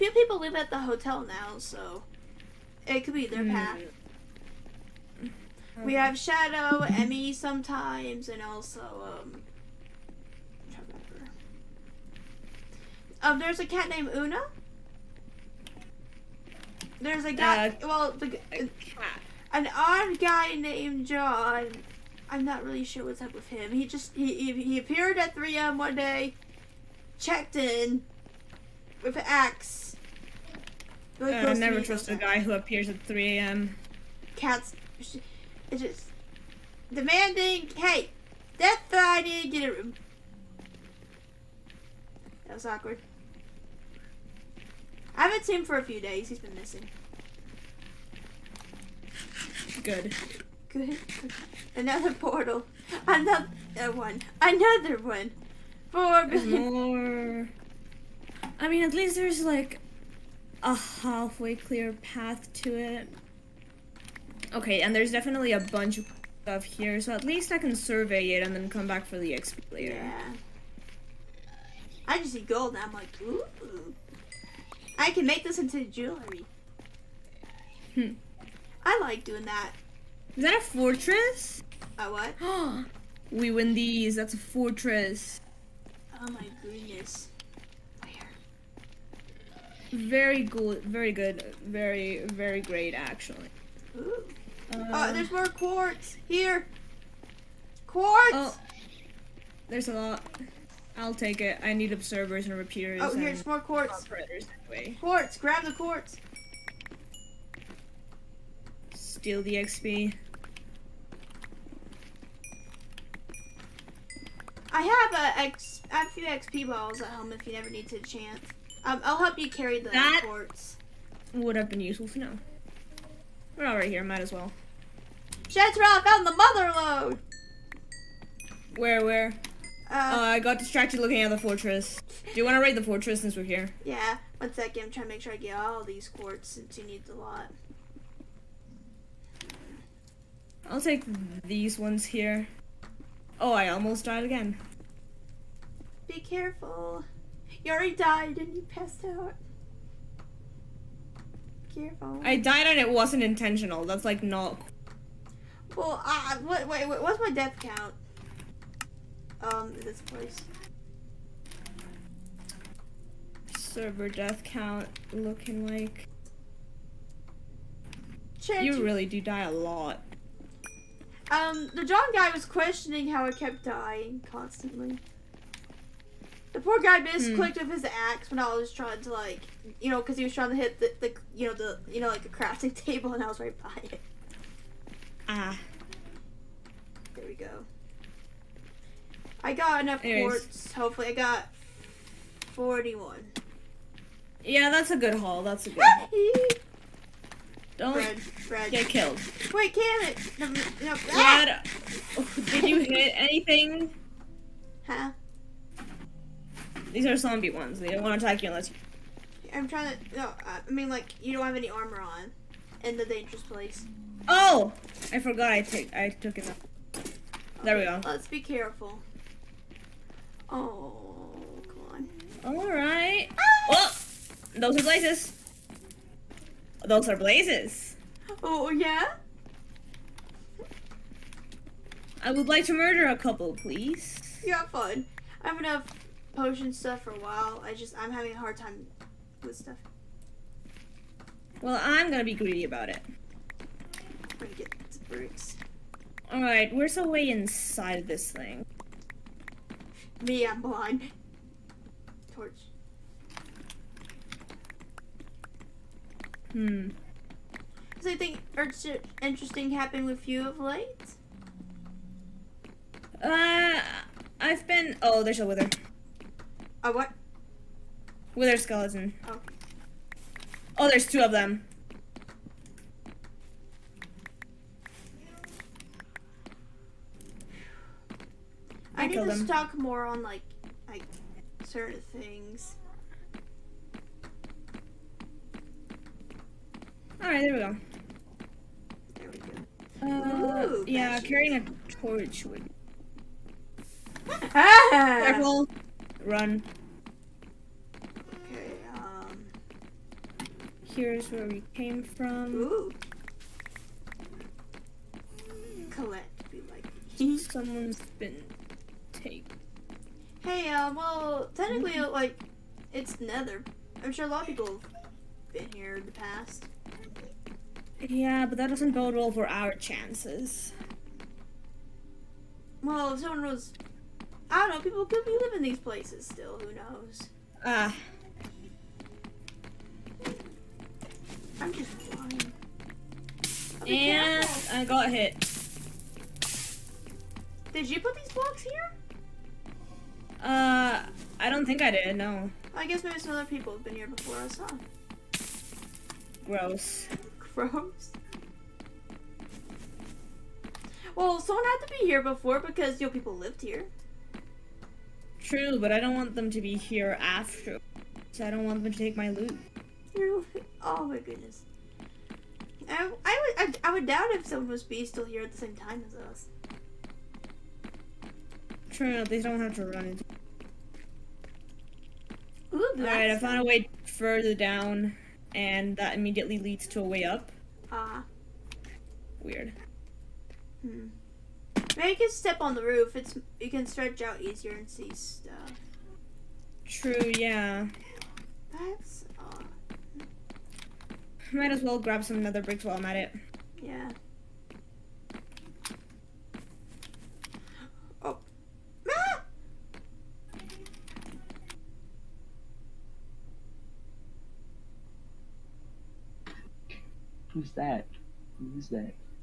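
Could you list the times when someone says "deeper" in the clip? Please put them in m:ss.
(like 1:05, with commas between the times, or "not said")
not said.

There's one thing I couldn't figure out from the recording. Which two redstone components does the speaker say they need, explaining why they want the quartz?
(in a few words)
Observers and repeaters.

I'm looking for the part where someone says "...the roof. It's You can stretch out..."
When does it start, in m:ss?
6:22.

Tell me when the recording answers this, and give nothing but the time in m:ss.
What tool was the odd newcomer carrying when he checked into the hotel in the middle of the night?
0:29.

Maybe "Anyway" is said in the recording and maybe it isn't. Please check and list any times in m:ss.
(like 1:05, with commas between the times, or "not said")
1:44, 3:10.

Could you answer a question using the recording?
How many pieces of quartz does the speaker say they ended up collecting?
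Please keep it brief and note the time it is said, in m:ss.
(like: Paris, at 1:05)
41, at 3:12.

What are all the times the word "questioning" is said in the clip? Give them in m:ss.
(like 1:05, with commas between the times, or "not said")
2:52.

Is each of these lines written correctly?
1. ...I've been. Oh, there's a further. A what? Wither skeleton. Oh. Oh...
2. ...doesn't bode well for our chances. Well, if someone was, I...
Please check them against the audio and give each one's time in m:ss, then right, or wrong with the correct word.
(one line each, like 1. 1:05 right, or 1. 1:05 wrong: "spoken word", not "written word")
1. 4:24 wrong: "wither", not "further"
2. 5:18 right.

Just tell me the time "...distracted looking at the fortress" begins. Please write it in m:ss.
2:10.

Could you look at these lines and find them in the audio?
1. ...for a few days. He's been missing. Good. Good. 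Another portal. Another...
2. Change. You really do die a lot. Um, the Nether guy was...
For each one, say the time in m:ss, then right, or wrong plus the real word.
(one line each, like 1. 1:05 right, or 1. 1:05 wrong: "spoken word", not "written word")
1. 0:45 right
2. 2:48 wrong: "John", not "Nether".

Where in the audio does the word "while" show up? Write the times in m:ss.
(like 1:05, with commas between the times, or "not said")
3:57, 6:32.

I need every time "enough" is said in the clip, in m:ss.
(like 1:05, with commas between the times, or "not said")
3:09, 3:55.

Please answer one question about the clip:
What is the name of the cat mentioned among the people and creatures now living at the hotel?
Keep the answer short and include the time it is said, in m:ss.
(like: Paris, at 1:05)
Una, at 0:14.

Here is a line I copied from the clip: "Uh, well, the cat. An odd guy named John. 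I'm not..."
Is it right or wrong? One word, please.
right.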